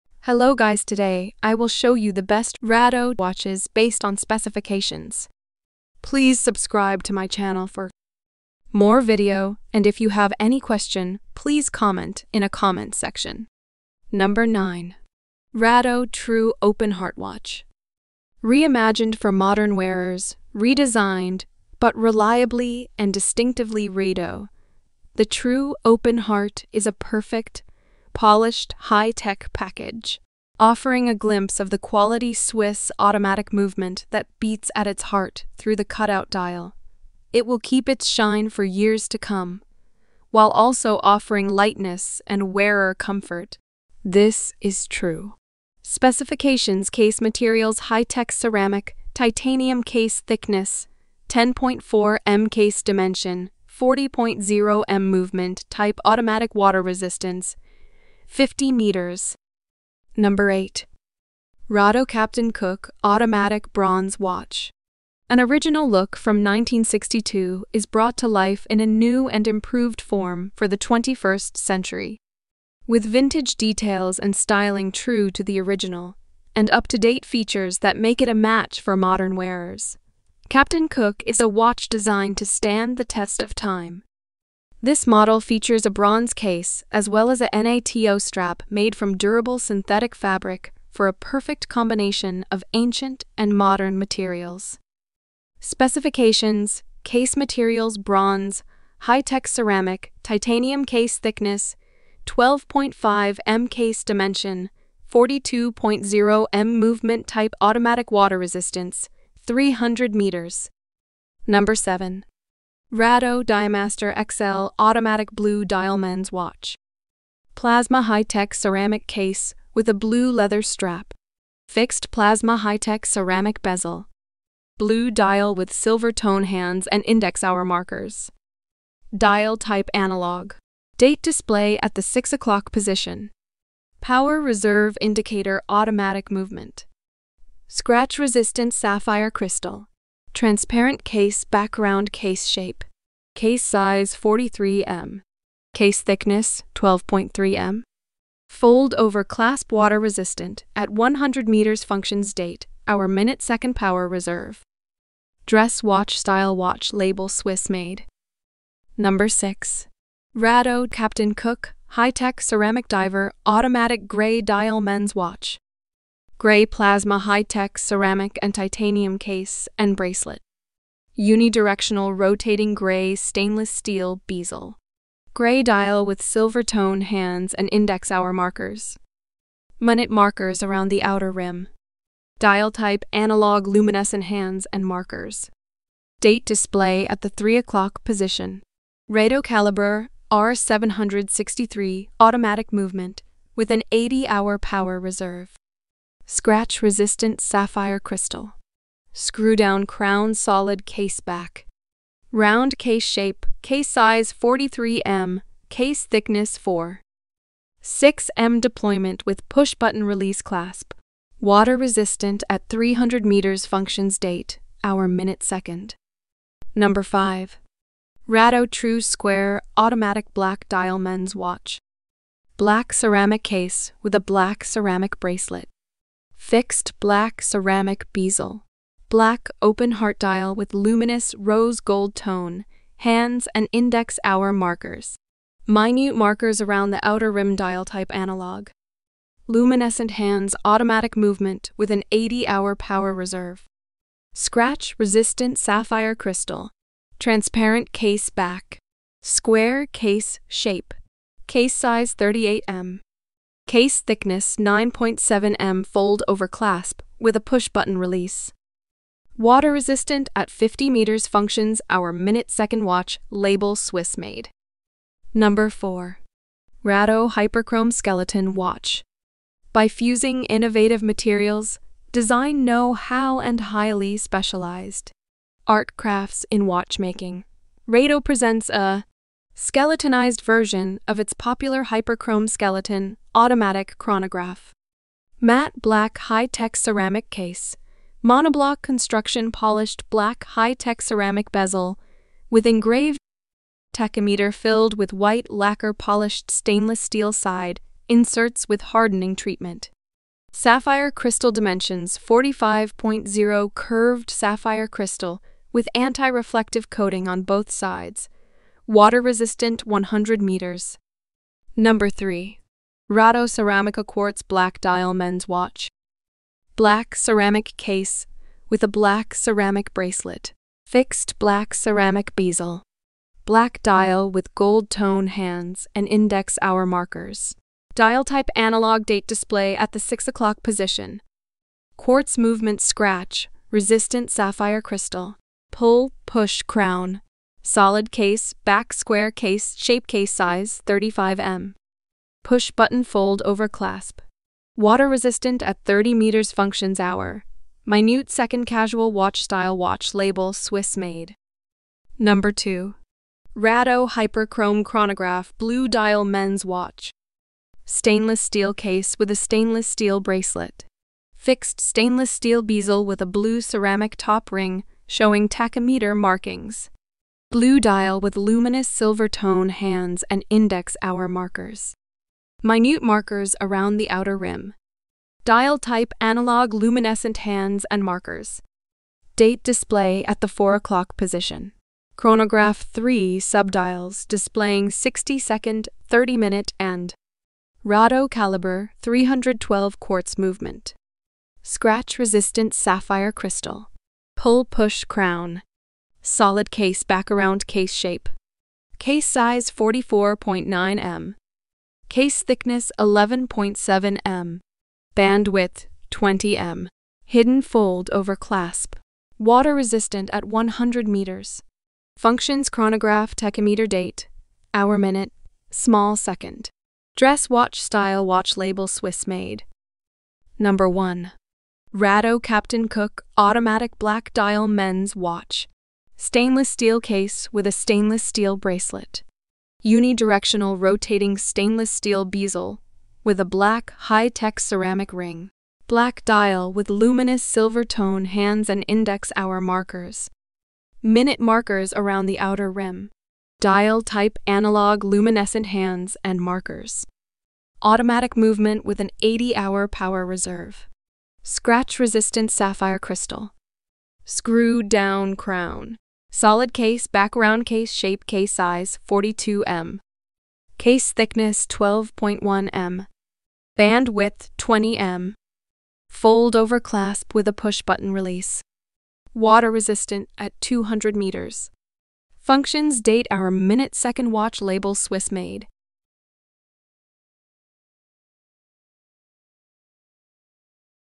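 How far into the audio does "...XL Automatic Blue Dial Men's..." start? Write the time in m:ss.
1:54.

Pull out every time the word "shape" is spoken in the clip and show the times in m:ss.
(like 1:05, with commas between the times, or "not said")
2:22, 3:23, 4:10, 5:39, 6:37, 7:37.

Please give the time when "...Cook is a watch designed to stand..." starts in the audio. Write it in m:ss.
1:20.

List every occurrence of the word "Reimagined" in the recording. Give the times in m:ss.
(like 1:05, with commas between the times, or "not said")
0:18.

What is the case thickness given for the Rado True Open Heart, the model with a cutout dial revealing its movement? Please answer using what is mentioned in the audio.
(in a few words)
10.4 mm.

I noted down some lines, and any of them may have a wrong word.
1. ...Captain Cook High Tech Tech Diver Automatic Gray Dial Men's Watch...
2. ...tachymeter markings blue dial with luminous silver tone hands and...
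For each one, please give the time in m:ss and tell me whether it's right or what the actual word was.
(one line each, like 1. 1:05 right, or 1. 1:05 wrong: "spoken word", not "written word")
1. 2:40 wrong: "Ceramic", not "Tech"
2. 6:05 right.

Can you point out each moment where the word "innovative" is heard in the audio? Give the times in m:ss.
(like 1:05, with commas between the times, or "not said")
4:30.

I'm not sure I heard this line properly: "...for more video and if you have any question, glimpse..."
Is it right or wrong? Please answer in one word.
wrong.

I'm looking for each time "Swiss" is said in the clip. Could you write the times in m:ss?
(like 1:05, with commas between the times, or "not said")
0:32, 2:37, 4:23, 5:50, 6:58, 7:54.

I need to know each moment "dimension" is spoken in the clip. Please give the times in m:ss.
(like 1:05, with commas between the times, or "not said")
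0:52, 1:44, 5:01.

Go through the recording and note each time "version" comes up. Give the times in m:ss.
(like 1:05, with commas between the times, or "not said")
4:40.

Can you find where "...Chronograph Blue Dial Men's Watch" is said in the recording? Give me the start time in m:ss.
5:54.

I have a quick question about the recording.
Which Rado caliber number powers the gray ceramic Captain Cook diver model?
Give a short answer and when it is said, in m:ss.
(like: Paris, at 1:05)
R763, at 3:10.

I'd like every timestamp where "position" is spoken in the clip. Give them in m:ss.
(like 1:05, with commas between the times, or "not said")
2:12, 3:08, 5:30, 6:21.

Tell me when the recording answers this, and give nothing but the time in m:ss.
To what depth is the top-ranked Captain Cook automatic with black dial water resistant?
7:50.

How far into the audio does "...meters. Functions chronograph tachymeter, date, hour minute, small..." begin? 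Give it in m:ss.
6:51.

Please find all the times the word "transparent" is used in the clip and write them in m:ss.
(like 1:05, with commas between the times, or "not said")
2:20, 4:07.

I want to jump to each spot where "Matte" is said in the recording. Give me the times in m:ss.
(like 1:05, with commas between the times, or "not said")
4:45.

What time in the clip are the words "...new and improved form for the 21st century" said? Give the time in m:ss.
1:08.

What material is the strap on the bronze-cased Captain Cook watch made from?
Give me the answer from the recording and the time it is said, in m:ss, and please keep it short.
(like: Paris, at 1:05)
Durable synthetic fabric, at 1:29.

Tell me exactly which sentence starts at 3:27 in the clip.
6M deployment with push button release clasp.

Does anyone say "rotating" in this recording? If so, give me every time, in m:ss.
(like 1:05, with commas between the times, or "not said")
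2:52, 7:10.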